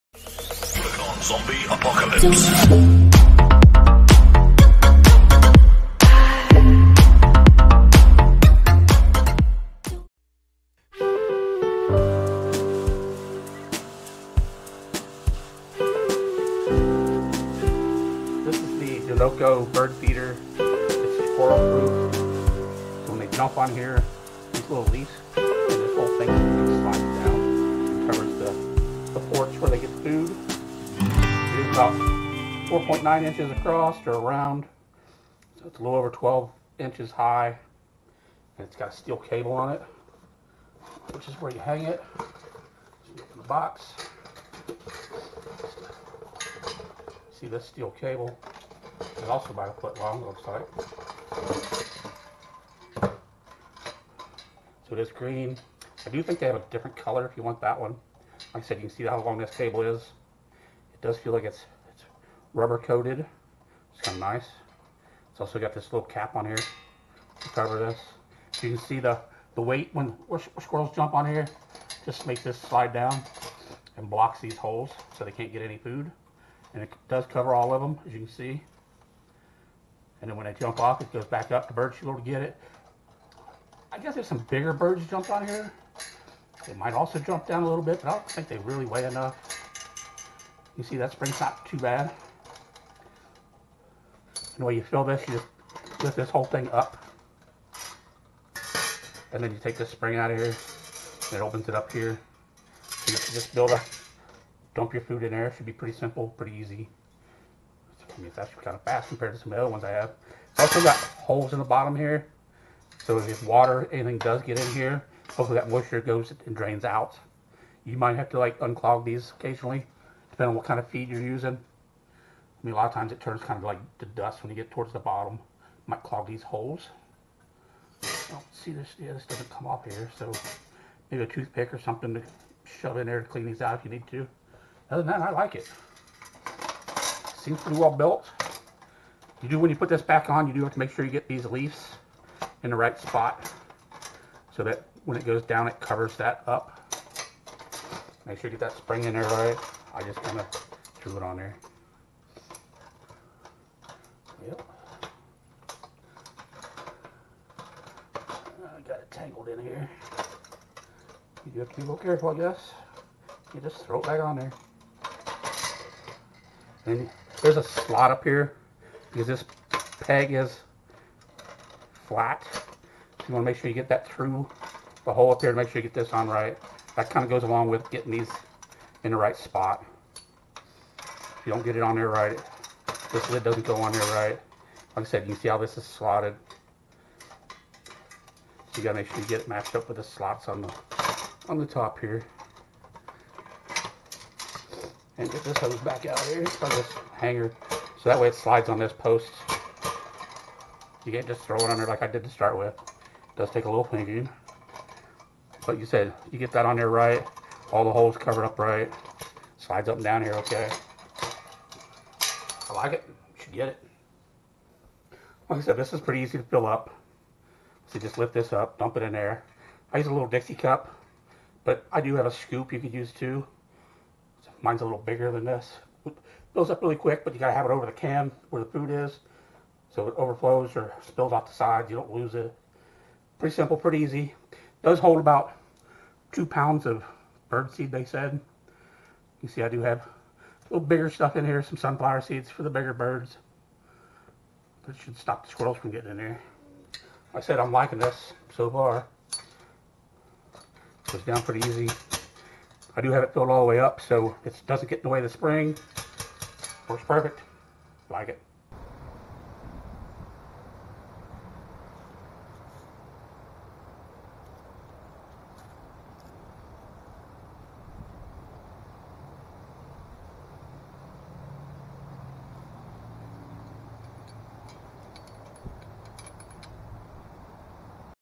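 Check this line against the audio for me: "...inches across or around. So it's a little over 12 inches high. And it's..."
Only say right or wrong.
right.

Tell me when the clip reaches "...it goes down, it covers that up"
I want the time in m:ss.
2:25.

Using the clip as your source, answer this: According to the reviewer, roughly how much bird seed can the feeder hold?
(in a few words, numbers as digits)
2 pounds.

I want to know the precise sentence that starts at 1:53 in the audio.
So if water, anything does get in here, hopefully that moisture goes and drains out.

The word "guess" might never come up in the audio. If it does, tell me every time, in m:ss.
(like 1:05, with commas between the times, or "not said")
1:23, 2:42.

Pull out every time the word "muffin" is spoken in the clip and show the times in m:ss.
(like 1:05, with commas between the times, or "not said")
not said.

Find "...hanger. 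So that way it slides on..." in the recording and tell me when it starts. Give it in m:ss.
3:17.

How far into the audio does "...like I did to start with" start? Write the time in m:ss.
3:21.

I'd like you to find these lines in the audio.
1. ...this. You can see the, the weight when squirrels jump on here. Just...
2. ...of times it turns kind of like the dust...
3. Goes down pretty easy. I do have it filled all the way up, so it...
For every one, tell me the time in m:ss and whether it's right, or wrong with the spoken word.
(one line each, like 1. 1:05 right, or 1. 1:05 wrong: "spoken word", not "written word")
1. 1:07 right
2. 2:02 right
3. 4:11 right.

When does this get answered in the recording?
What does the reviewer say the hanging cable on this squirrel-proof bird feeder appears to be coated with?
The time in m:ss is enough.
1:02.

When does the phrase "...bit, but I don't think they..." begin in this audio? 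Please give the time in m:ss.
1:27.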